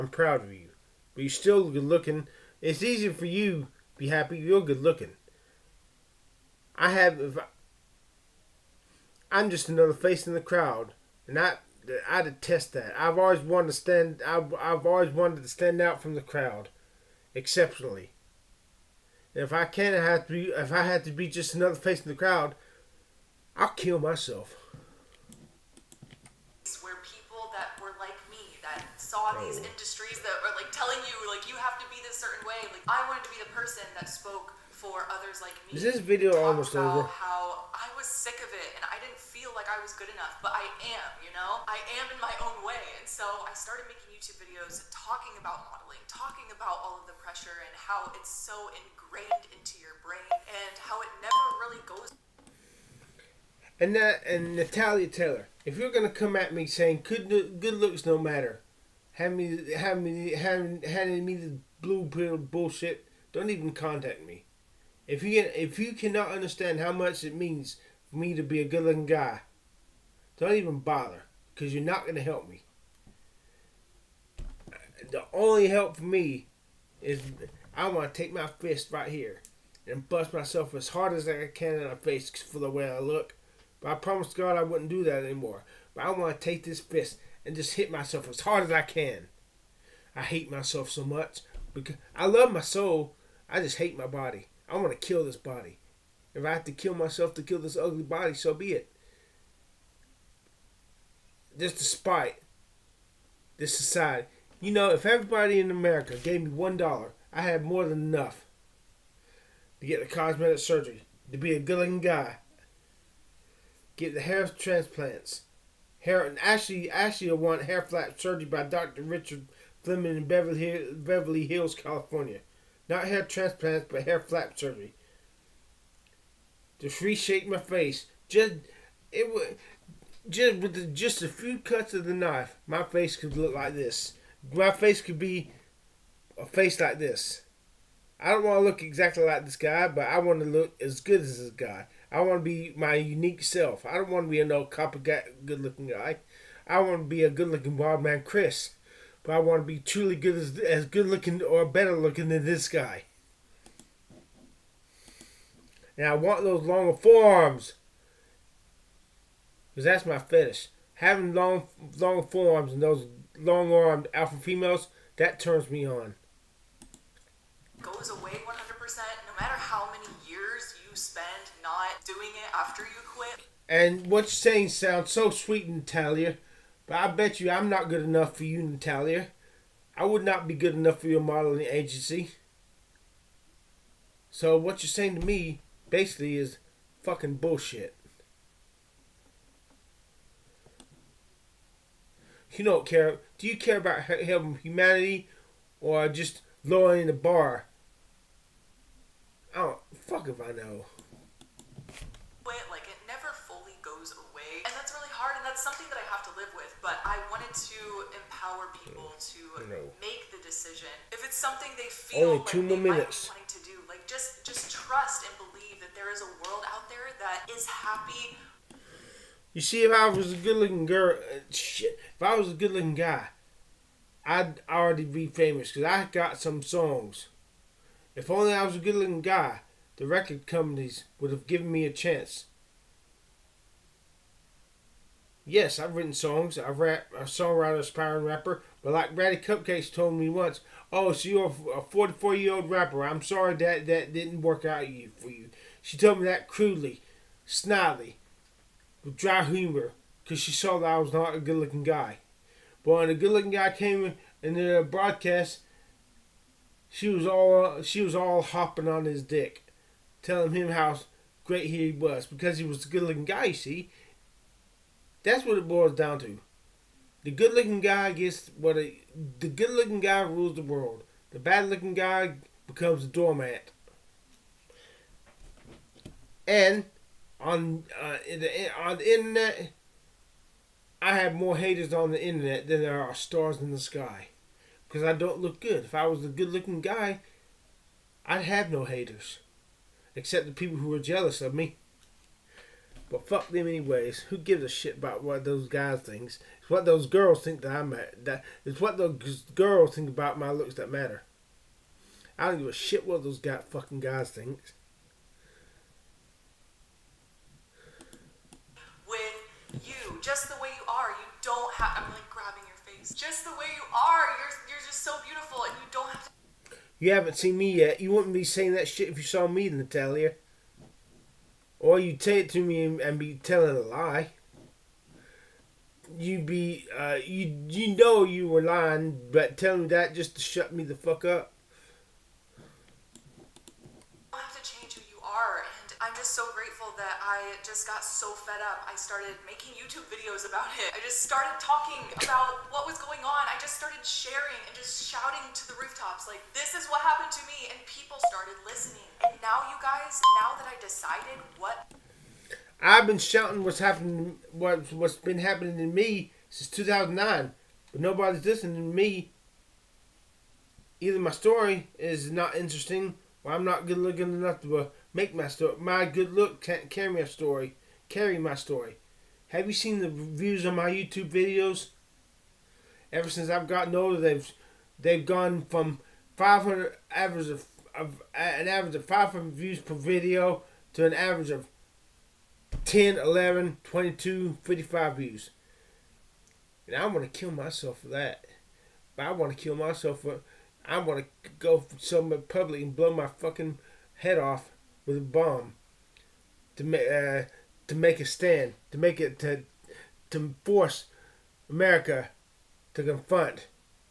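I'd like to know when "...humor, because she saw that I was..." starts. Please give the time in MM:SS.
04:09.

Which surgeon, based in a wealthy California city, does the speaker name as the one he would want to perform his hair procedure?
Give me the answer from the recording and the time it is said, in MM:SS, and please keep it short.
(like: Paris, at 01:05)
Dr. Richard Fleming, at 01:59.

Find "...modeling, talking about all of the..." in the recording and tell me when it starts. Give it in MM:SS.
00:45.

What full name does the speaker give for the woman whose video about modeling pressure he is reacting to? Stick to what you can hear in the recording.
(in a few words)
Natalia Taylor.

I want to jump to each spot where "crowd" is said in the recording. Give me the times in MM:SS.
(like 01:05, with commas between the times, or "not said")
00:10, 00:16, 00:22.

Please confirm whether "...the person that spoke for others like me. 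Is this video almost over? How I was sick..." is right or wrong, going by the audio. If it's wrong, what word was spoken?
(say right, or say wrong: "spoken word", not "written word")
right.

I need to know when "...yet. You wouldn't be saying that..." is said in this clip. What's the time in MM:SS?
05:17.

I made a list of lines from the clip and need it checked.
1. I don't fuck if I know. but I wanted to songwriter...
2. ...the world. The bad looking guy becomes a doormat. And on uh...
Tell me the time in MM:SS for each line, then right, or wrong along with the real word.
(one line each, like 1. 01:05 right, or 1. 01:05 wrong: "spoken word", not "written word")
1. 03:19 wrong: "empower", not "songwriter"
2. 04:30 right.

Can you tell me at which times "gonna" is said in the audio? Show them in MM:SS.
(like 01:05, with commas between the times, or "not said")
00:55, 01:12.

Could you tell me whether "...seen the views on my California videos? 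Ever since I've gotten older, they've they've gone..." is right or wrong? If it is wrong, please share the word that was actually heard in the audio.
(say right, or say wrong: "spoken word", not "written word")
wrong: "YouTube", not "California".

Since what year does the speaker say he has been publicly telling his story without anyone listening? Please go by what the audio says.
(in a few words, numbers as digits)
2009.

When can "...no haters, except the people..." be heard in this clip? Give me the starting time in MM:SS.
04:48.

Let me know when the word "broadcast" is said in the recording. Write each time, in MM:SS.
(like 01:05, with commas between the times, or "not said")
04:14.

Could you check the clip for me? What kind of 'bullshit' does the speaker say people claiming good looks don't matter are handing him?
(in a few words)
Blue pill.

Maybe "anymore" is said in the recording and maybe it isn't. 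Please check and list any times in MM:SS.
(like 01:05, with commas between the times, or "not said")
01:25.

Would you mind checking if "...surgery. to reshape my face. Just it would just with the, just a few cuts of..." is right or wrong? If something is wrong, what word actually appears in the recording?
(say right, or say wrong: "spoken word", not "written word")
right.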